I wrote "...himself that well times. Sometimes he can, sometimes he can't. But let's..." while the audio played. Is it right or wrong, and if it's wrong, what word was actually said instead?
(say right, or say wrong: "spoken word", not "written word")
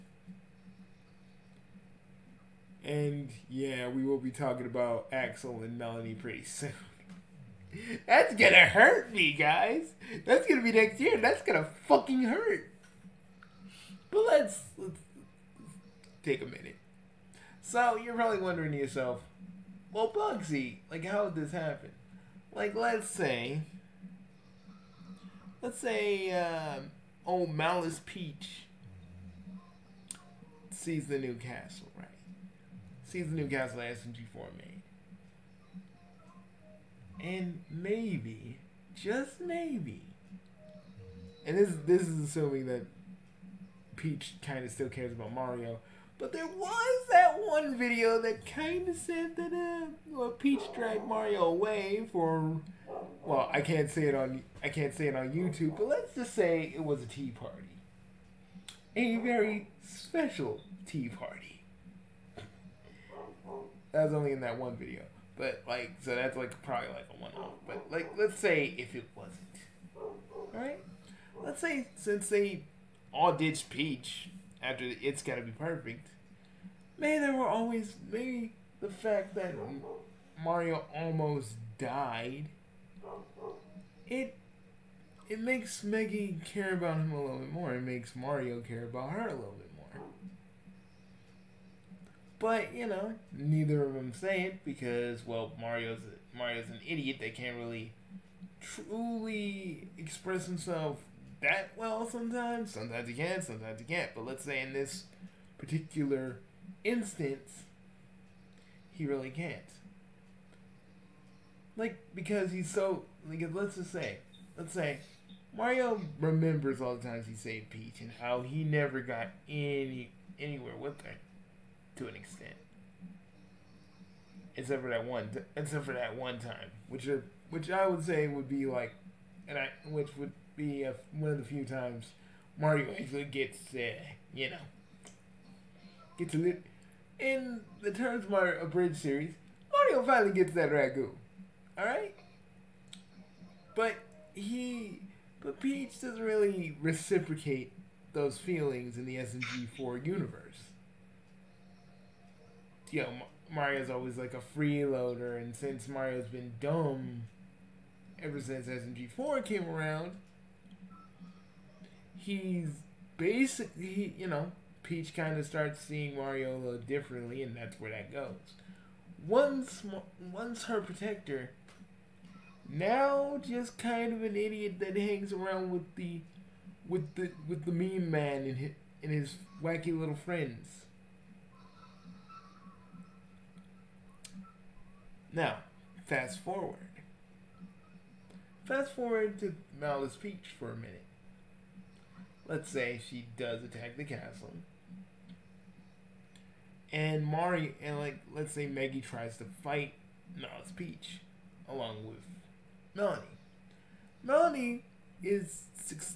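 wrong: "sometimes", not "times".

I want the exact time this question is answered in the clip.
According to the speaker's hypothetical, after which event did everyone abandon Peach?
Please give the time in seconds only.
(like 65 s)
74 s.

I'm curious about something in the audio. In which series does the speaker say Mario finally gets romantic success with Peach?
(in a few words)
Terms Mario Bridge.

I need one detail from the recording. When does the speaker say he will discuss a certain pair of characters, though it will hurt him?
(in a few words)
next year.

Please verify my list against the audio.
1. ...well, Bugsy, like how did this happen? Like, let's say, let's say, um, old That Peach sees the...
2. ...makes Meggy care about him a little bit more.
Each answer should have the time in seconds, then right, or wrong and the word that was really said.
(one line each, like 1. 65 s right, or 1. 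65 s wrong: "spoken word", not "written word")
1. 19 s wrong: "Malice", not "That"
2. 85 s right.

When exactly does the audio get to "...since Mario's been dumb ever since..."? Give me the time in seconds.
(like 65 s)
155 s.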